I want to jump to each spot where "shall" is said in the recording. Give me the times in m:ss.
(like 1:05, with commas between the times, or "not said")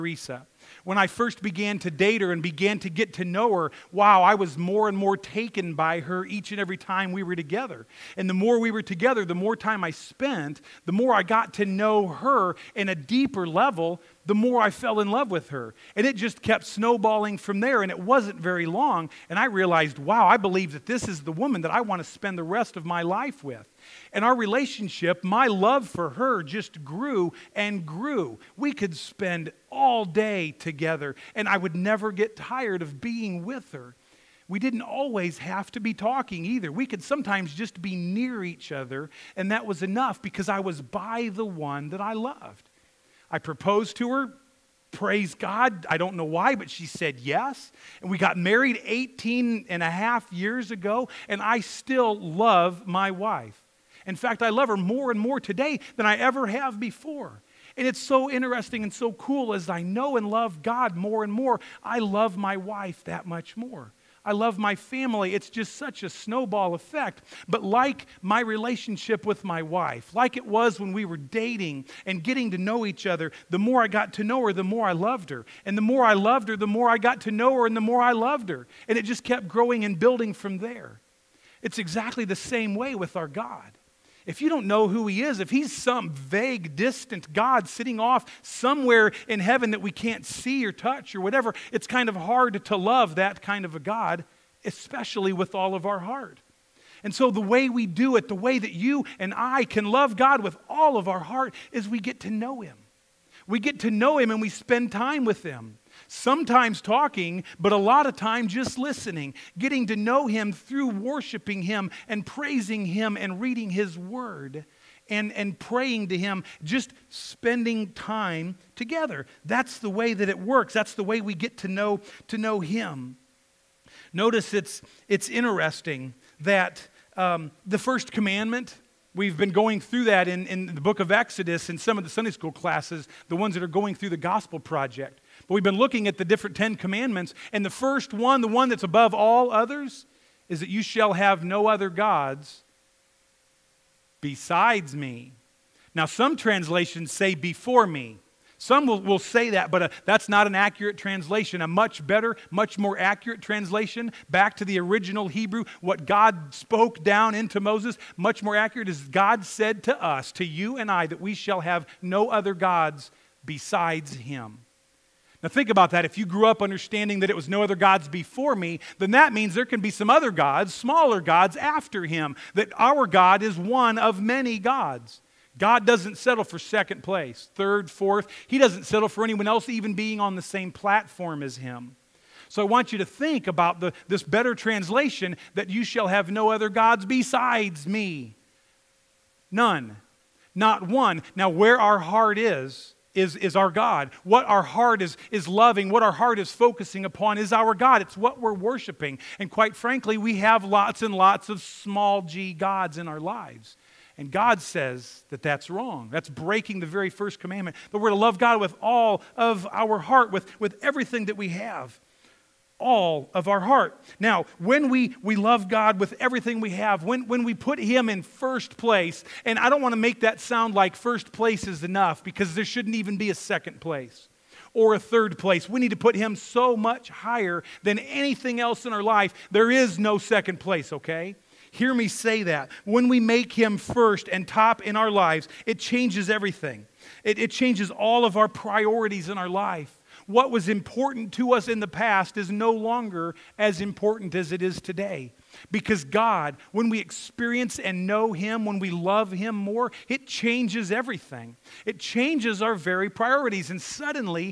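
2:20, 2:41, 3:05.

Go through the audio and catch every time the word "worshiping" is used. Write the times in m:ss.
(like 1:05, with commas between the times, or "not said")
1:50, 3:18.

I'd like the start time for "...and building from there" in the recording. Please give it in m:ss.
1:19.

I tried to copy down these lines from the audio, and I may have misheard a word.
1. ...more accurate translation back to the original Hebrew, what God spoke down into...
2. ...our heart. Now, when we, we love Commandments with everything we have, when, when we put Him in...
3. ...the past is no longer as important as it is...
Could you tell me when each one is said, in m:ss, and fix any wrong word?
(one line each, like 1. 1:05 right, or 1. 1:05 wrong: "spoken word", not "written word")
1. 2:32 right
2. 3:33 wrong: "God", not "Commandments"
3. 4:01 right.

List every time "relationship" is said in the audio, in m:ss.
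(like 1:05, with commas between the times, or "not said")
0:24, 1:08.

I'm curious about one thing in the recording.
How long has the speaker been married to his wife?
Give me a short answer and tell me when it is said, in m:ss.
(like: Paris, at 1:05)
18 and a half years, at 0:48.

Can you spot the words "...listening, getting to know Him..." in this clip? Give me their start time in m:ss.
1:48.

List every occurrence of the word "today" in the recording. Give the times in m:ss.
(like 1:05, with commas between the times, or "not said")
0:55, 4:04.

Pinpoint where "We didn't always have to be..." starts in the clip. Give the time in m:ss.
0:34.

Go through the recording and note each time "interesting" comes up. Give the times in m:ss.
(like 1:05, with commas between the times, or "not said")
0:58, 2:05.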